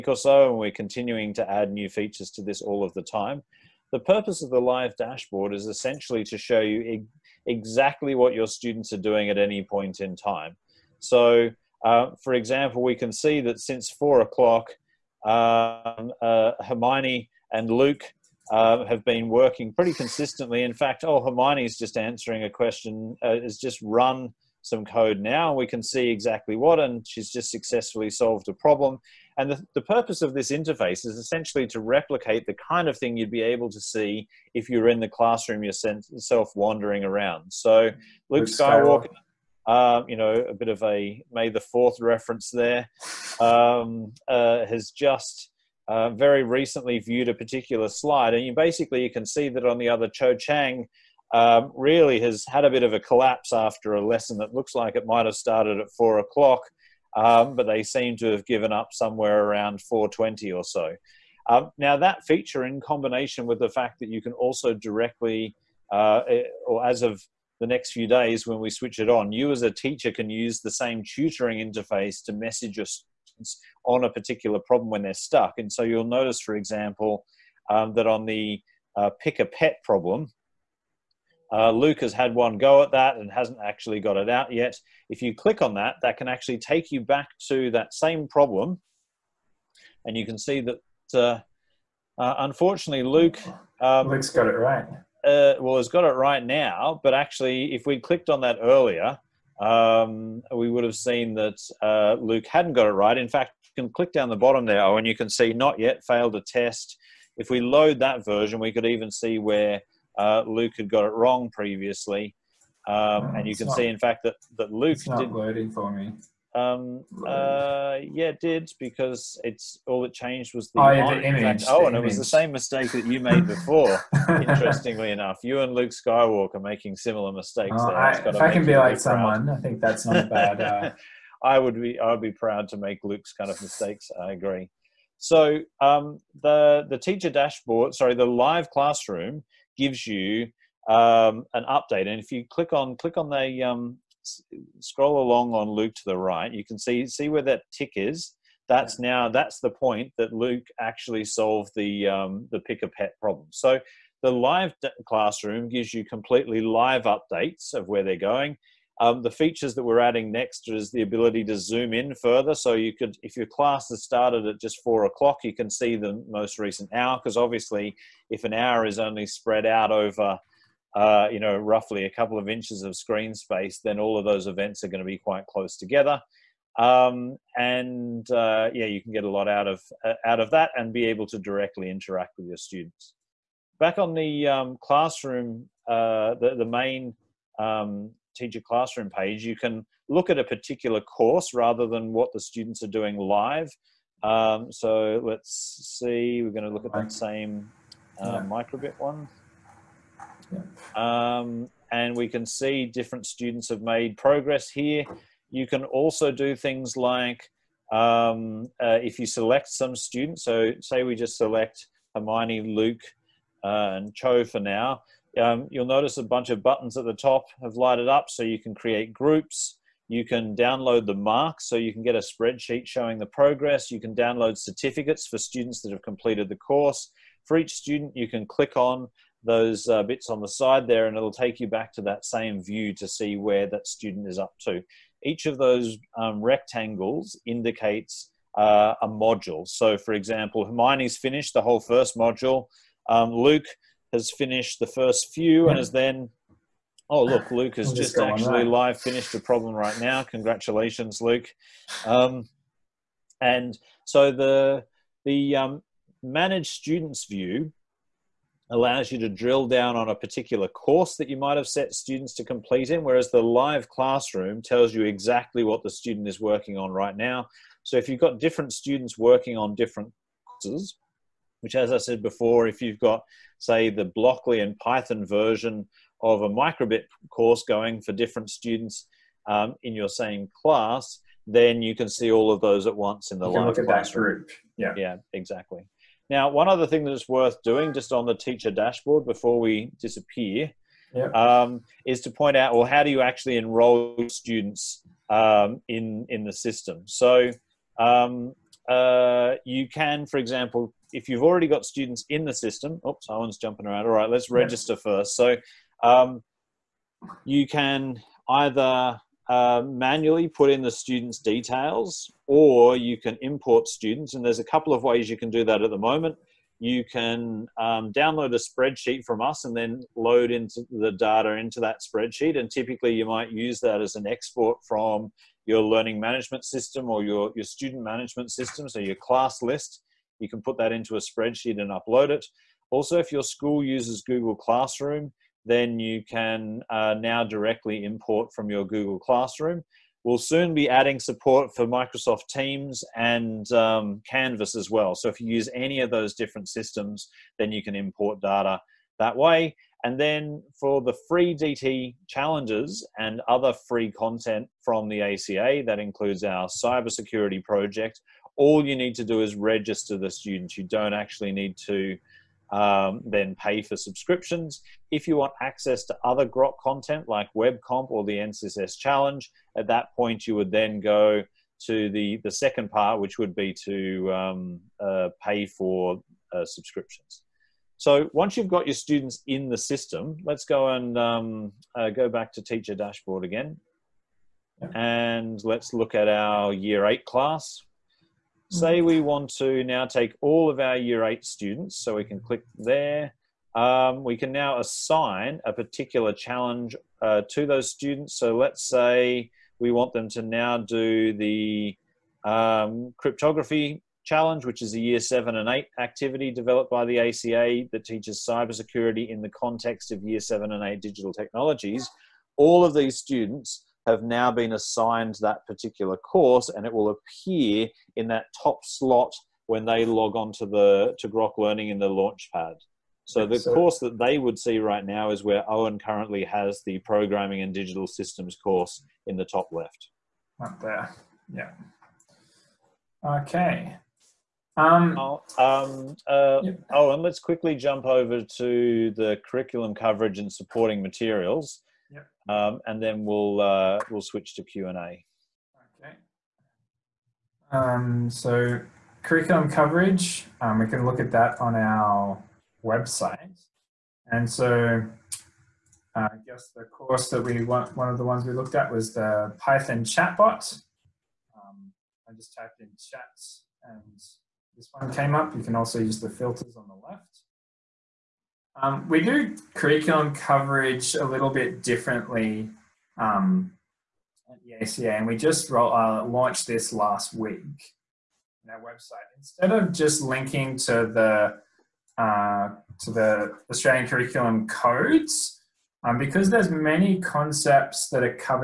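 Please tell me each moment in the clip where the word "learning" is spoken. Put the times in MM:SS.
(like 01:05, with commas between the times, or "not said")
05:25, 07:01.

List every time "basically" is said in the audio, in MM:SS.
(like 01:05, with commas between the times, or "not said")
00:48.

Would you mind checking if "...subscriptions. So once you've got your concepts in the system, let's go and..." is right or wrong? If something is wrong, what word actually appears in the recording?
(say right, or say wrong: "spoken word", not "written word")
wrong: "students", not "concepts".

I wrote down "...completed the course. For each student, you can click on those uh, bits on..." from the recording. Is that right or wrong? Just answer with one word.
right.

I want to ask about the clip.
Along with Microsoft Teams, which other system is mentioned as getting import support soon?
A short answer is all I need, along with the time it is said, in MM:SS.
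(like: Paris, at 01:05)
Canvas, at 05:44.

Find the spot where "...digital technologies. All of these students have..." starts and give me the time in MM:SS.
06:51.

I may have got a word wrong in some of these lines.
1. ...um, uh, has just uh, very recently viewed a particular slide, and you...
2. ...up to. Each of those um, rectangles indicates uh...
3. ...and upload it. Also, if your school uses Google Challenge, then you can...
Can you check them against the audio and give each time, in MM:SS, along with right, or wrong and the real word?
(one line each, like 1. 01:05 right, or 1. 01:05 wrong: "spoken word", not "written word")
1. 00:43 right
2. 03:54 right
3. 05:31 wrong: "Classroom", not "Challenge".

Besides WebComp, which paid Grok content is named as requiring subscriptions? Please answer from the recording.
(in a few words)
NCSS Challenge.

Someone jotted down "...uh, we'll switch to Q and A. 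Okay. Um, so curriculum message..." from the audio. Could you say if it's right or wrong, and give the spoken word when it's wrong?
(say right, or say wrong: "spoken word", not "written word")
wrong: "coverage", not "message".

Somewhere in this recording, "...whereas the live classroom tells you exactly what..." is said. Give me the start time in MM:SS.
04:23.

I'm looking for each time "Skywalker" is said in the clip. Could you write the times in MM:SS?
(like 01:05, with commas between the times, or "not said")
00:38, 02:05.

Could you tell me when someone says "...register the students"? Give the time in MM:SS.
05:59.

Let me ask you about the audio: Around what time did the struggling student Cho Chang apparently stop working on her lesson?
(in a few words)
4:20.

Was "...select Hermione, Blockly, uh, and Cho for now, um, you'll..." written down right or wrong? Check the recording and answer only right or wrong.
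wrong.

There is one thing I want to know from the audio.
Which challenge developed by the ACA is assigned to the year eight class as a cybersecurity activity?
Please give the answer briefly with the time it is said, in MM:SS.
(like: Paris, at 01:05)
Cryptography challenge, at 06:43.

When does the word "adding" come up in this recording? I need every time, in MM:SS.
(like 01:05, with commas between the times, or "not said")
02:39, 05:40.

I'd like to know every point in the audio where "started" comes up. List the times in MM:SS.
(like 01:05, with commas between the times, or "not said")
00:55, 02:44.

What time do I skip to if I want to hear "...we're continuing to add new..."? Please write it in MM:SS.
00:00.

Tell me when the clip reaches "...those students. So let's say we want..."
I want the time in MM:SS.
06:37.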